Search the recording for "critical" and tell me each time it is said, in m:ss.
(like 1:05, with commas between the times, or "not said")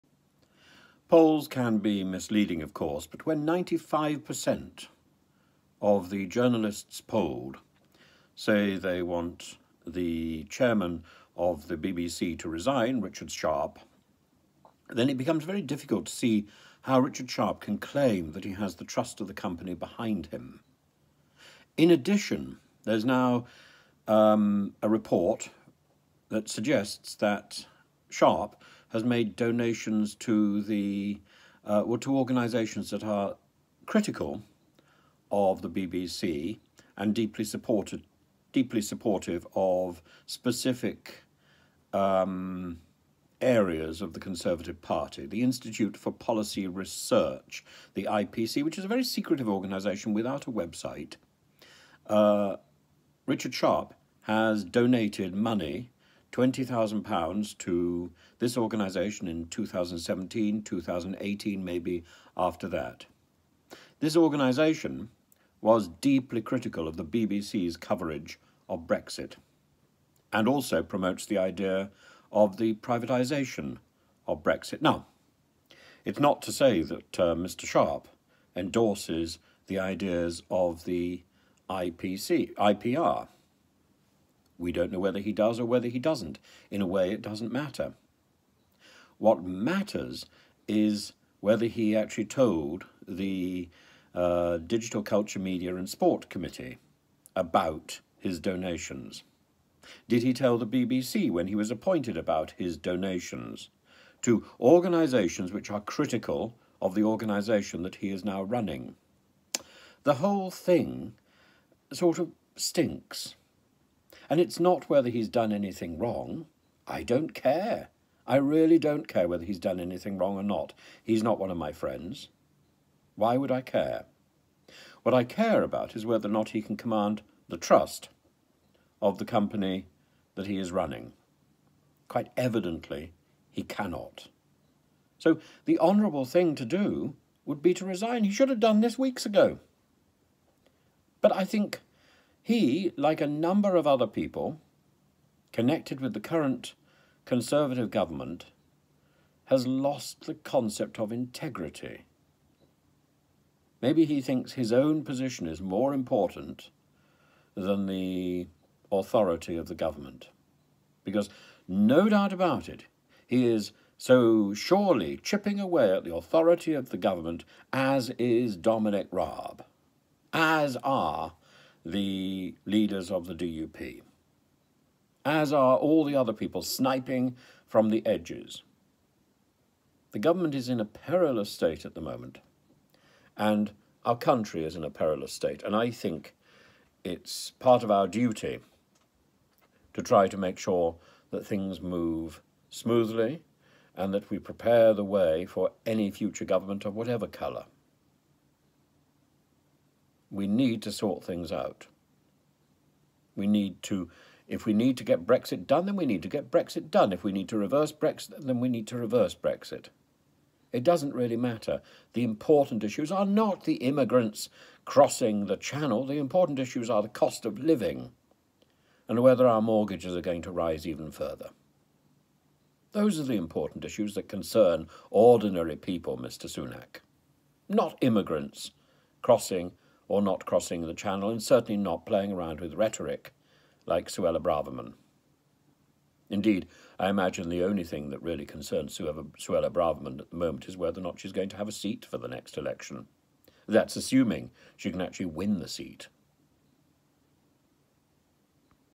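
0:33, 1:06, 1:45.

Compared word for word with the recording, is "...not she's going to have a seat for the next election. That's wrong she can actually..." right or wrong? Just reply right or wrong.
wrong.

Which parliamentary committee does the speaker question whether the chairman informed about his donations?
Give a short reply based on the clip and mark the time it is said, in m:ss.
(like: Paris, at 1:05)
Digital Culture, Media and Sport Committee, at 1:34.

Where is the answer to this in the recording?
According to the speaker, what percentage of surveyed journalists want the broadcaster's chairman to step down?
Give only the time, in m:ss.
0:03.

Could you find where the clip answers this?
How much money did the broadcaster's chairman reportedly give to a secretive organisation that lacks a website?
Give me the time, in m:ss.
0:56.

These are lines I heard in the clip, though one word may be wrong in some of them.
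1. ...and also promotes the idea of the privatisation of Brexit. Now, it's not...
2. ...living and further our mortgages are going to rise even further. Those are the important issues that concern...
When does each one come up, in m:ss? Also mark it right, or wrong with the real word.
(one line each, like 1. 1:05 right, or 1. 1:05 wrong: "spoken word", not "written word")
1. 1:10 right
2. 3:37 wrong: "whether", not "further".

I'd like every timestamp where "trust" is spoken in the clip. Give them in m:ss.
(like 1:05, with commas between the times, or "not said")
0:18, 2:07.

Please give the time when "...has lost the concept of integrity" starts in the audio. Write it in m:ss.
2:29.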